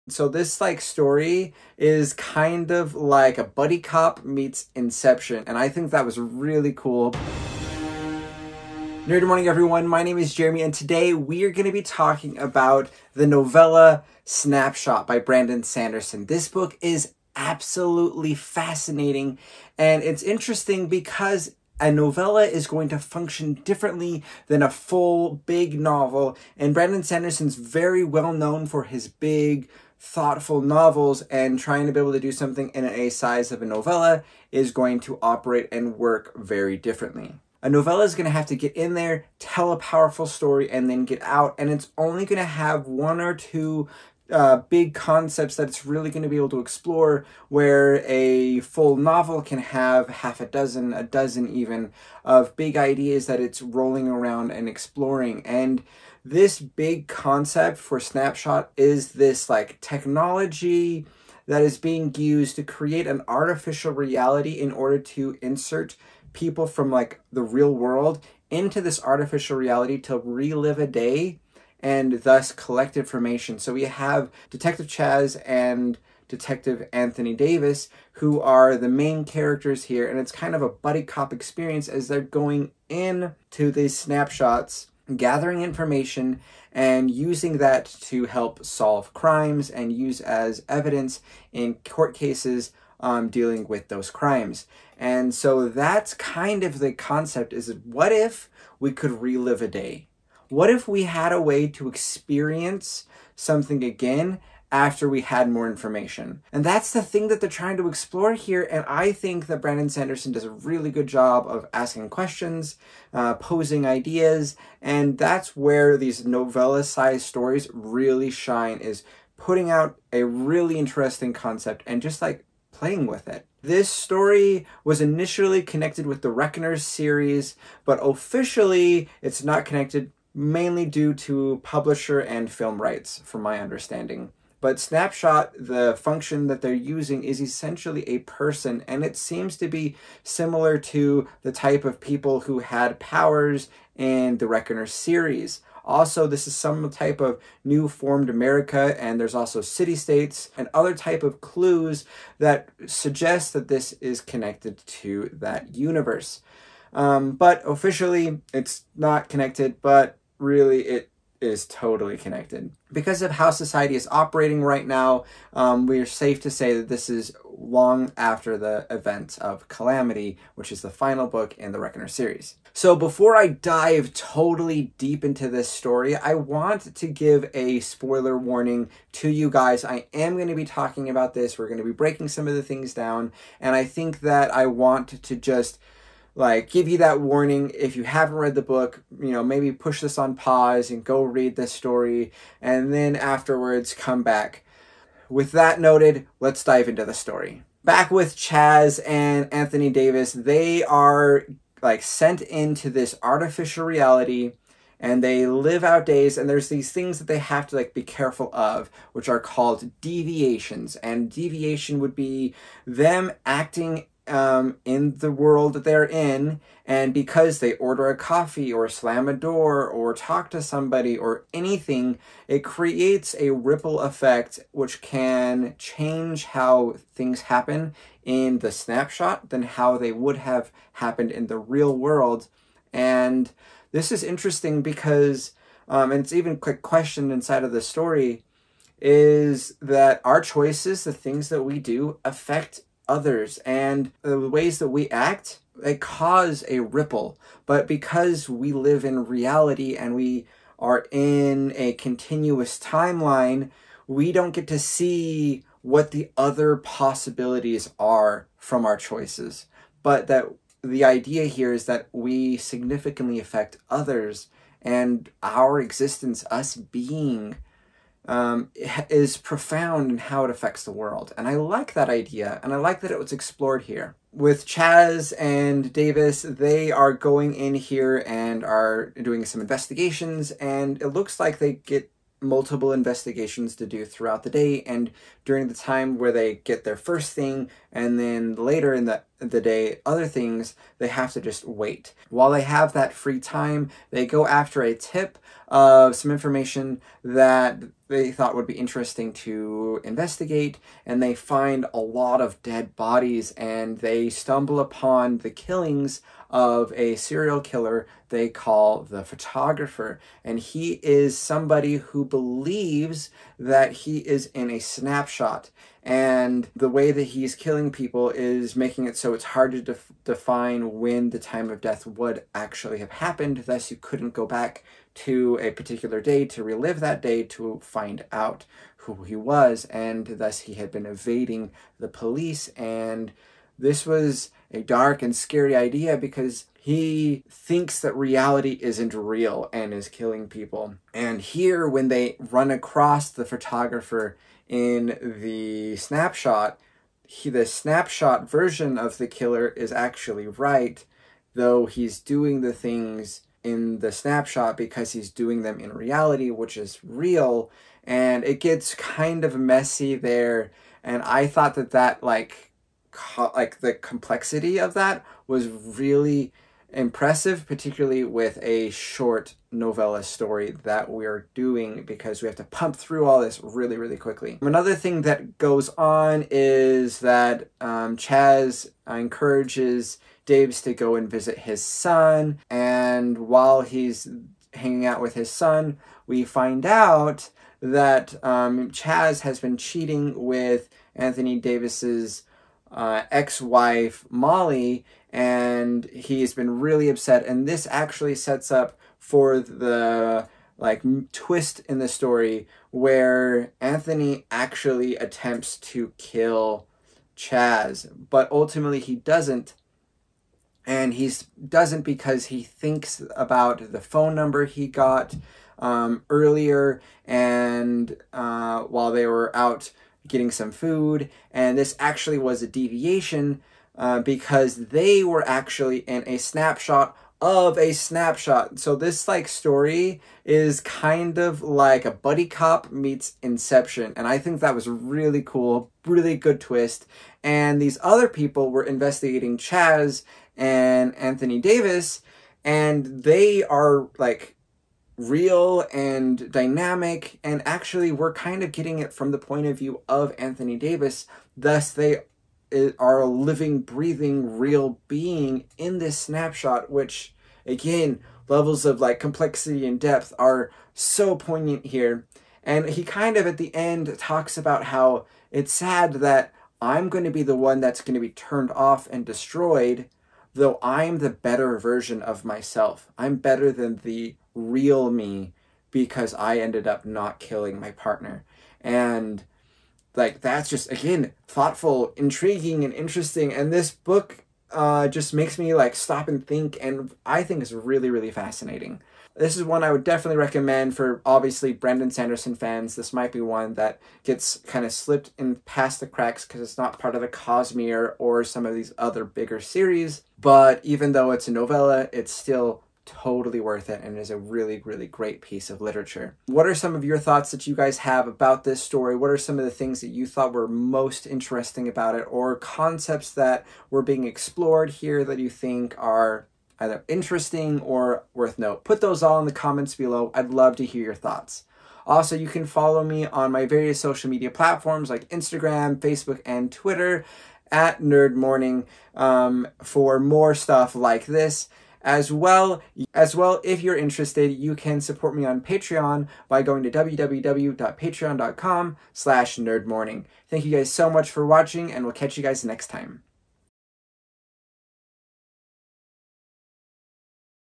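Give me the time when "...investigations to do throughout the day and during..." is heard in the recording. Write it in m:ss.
4:42.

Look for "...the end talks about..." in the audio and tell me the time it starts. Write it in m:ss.
7:43.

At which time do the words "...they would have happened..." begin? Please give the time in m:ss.
3:49.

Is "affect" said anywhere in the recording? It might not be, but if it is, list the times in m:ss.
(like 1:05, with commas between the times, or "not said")
4:02, 4:23, 4:30.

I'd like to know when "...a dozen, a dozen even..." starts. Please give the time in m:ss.
0:50.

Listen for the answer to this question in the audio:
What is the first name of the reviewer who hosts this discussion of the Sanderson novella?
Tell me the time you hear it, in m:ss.
0:10.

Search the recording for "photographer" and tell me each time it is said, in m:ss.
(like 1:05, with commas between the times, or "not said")
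5:09, 5:43.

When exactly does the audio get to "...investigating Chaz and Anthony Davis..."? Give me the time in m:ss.
7:18.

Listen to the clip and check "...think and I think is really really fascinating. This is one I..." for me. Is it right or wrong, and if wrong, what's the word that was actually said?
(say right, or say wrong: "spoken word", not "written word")
right.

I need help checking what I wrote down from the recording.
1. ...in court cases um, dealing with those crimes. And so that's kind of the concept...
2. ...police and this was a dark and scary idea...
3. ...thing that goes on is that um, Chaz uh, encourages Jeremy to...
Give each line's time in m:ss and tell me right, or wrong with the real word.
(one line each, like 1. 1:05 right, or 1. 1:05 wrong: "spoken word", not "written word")
1. 1:31 right
2. 5:32 right
3. 6:14 wrong: "Davis", not "Jeremy".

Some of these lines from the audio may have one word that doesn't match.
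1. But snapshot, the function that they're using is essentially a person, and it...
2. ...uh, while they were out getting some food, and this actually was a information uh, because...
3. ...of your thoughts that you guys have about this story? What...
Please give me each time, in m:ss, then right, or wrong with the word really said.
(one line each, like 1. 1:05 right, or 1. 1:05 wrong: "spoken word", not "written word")
1. 2:14 right
2. 6:58 wrong: "deviation", not "information"
3. 8:26 right.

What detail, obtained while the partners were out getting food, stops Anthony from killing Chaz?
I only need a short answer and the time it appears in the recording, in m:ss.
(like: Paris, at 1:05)
Phone number, at 6:54.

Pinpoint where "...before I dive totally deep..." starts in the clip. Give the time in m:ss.
2:52.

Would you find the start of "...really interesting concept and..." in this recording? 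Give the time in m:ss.
2:00.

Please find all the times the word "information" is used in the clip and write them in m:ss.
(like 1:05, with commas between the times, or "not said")
1:12, 1:25, 1:45, 4:56.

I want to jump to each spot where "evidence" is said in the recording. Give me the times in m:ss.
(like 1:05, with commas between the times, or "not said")
1:30.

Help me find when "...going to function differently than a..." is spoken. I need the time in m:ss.
0:22.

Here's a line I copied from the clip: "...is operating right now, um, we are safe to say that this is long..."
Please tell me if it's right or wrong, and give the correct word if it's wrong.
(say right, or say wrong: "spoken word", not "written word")
right.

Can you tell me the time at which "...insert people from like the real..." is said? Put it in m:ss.
1:05.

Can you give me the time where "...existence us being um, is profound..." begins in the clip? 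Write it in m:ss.
4:25.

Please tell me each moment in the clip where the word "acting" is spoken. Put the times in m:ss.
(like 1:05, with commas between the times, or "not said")
3:33.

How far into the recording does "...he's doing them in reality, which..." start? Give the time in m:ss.
5:55.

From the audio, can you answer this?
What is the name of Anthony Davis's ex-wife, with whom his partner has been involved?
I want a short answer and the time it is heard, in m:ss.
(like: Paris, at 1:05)
Molly, at 6:34.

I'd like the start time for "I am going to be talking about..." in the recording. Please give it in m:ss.
2:59.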